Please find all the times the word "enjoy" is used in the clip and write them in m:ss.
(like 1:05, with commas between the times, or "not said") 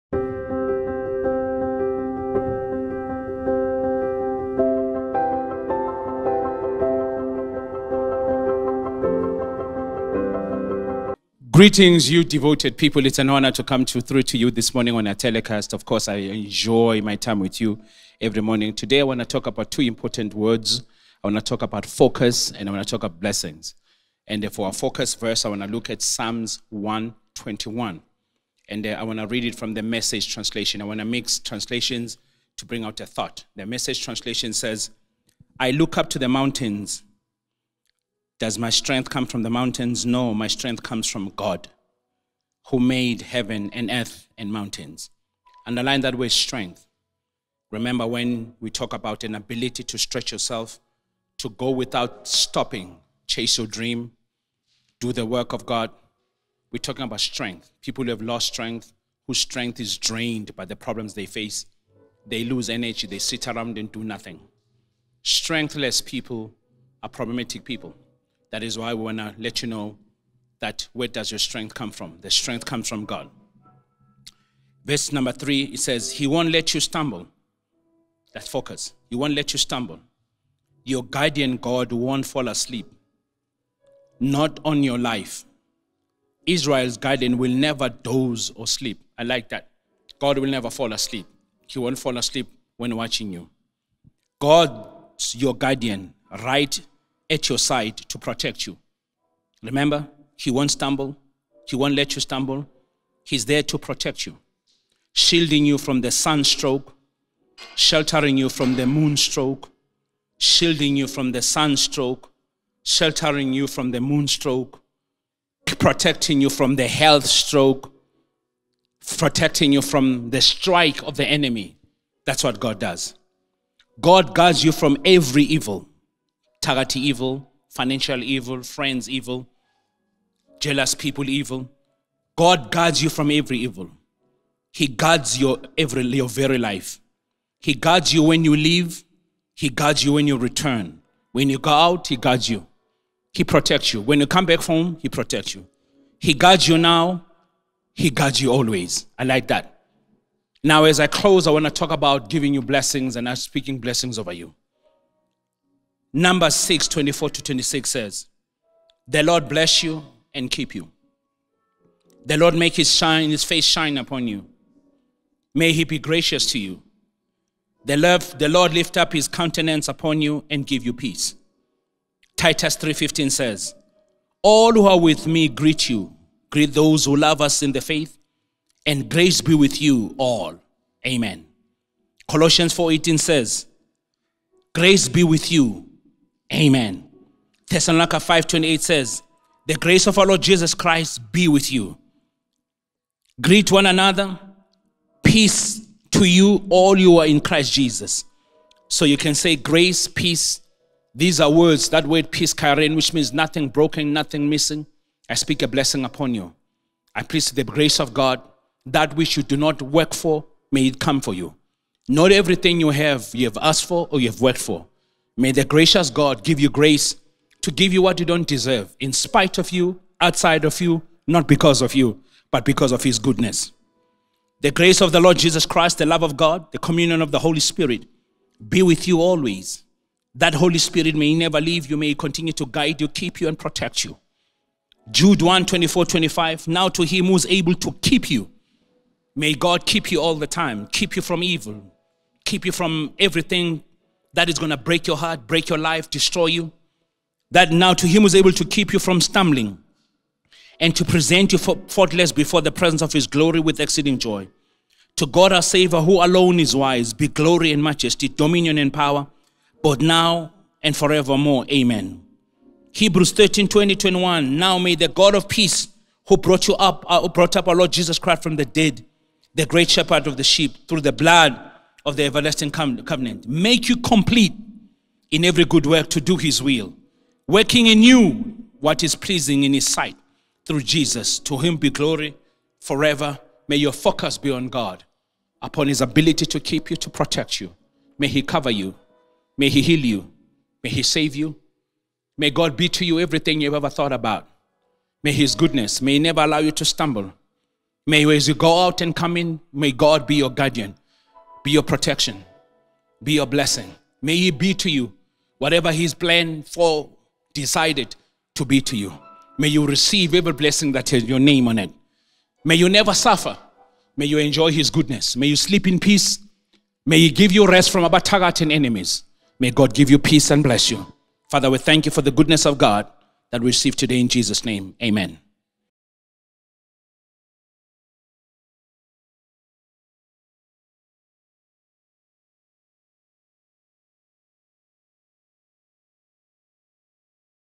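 0:16, 5:14.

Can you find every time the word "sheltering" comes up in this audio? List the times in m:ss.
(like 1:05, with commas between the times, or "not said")
1:47, 1:52.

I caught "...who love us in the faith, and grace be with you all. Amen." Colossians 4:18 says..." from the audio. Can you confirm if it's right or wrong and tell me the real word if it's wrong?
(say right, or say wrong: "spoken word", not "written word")
right.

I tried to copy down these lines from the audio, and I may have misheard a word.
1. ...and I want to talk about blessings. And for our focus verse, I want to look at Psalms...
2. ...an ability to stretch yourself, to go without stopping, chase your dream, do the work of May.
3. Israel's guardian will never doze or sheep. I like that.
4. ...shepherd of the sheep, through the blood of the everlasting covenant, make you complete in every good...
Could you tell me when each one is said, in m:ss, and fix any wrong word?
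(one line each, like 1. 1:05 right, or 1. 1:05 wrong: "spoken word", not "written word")
1. 0:22 right
2. 0:49 wrong: "God", not "May"
3. 1:26 wrong: "sleep", not "sheep"
4. 4:29 right.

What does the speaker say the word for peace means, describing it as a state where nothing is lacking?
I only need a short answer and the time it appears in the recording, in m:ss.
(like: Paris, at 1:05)
Nothing broken, nothing missing, at 3:23.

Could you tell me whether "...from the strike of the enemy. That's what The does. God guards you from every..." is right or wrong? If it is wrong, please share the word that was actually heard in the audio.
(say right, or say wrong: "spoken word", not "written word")
wrong: "God", not "The".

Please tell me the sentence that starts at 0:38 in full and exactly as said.
Does my strength come from the mountains?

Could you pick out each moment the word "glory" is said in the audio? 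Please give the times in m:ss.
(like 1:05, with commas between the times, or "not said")
4:13, 4:17, 4:41.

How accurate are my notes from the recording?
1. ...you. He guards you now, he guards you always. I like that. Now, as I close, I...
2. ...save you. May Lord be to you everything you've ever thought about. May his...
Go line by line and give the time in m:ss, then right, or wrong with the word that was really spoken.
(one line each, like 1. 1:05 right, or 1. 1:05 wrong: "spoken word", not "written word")
1. 2:25 right
2. 4:51 wrong: "God", not "Lord".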